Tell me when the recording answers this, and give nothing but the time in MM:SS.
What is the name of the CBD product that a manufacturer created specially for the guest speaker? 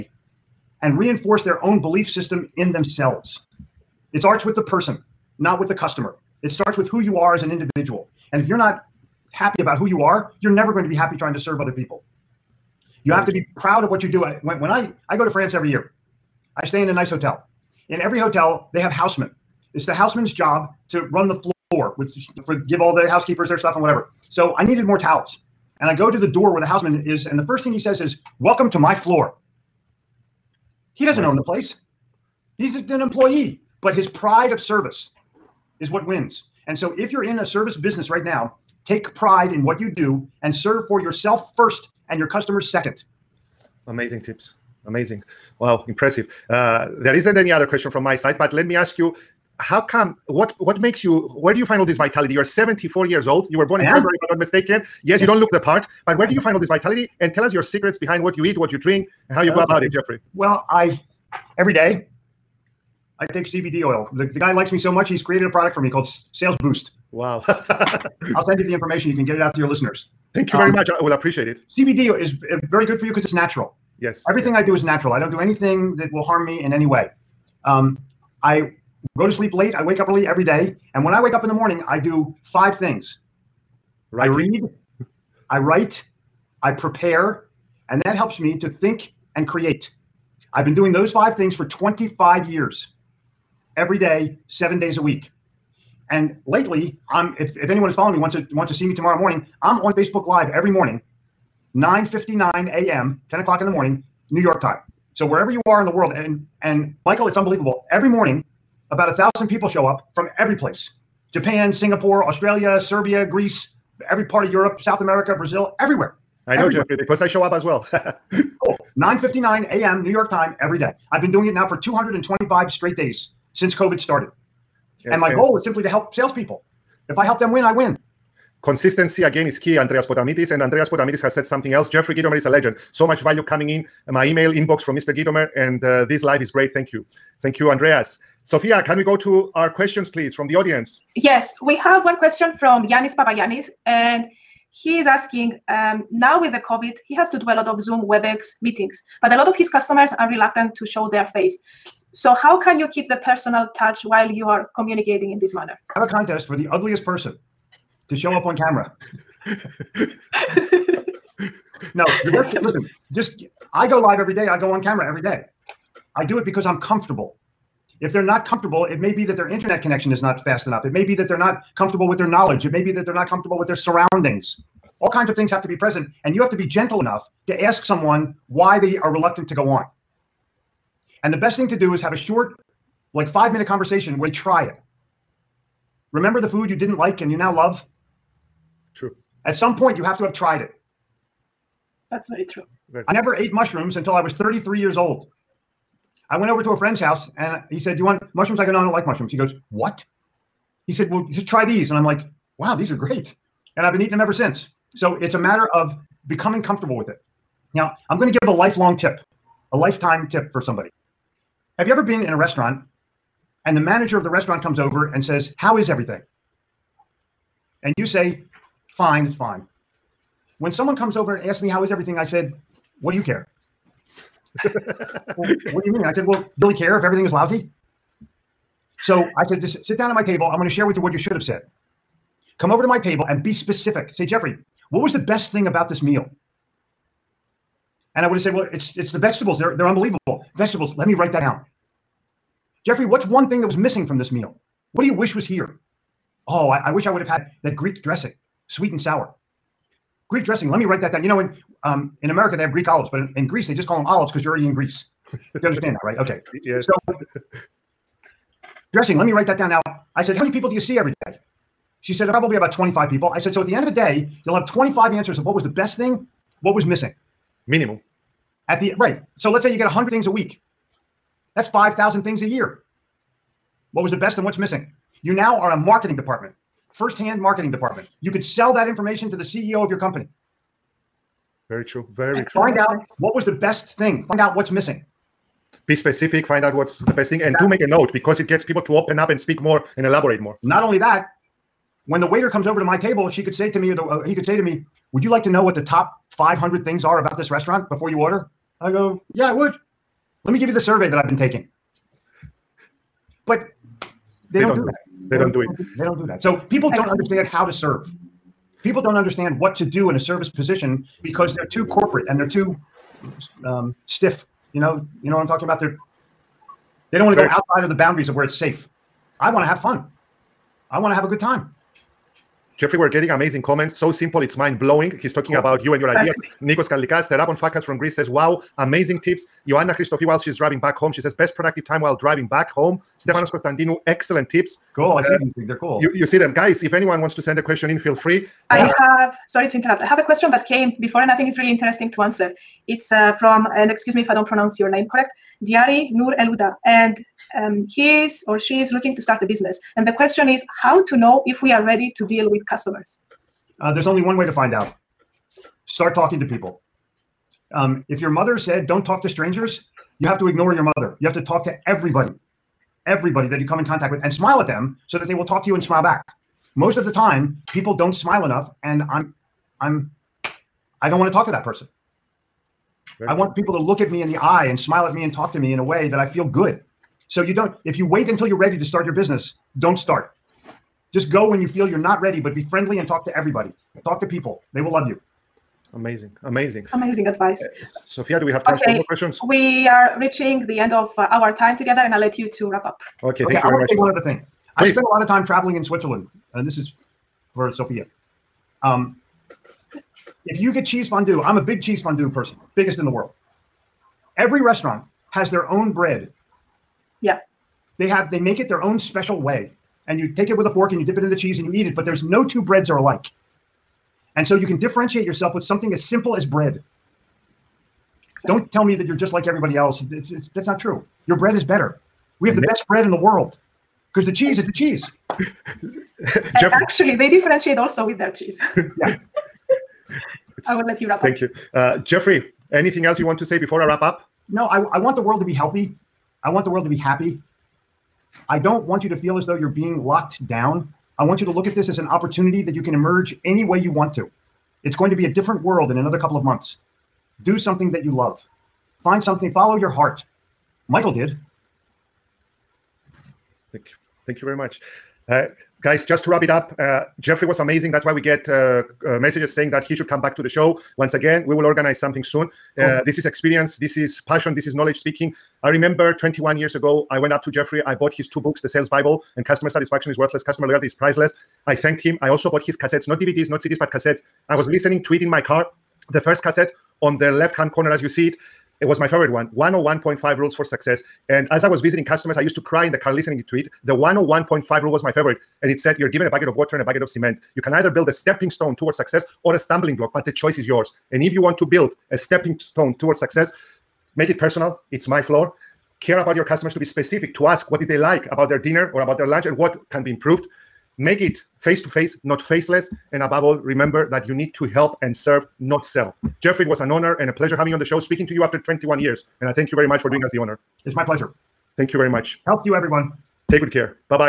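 01:06.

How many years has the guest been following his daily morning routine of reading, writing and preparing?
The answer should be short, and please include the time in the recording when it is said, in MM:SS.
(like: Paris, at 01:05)
25, at 01:31.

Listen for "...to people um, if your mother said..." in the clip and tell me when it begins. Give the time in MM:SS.
05:56.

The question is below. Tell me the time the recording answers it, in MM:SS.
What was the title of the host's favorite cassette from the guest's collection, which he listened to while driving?
07:59.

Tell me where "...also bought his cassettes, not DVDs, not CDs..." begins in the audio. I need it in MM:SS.
07:52.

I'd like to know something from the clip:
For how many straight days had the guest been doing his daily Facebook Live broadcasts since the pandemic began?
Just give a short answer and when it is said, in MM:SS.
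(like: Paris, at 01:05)
225, at 02:01.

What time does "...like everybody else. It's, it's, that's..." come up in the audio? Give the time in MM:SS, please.
06:59.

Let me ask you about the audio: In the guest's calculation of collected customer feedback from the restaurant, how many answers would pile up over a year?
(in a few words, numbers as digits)
5,000.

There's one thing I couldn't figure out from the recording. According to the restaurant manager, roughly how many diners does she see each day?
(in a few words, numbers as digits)
25.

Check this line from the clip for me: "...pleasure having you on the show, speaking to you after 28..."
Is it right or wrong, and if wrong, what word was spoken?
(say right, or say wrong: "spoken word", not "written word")
wrong: "21", not "28".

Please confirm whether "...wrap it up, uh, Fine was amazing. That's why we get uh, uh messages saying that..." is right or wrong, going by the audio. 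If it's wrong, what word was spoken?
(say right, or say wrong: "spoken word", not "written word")
wrong: "Jeffrey", not "Fine".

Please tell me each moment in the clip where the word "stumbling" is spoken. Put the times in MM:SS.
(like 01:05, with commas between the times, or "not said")
08:09.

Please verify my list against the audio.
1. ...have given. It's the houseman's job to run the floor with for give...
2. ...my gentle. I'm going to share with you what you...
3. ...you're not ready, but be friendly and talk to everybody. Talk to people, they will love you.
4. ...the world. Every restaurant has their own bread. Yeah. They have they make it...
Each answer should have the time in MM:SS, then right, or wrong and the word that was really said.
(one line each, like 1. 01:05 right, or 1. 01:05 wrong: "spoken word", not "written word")
1. 00:18 wrong: "housemen", not "given"
2. 03:50 wrong: "table", not "gentle"
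3. 06:21 right
4. 06:43 right.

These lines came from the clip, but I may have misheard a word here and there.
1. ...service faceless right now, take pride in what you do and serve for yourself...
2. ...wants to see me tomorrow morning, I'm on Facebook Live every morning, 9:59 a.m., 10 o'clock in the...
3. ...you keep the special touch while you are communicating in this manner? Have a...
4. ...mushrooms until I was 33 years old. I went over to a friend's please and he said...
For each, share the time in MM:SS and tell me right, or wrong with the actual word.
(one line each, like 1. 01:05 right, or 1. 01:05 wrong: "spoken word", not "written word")
1. 00:37 wrong: "business", not "faceless"
2. 01:38 right
3. 02:32 wrong: "personal", not "special"
4. 03:13 wrong: "house", not "please".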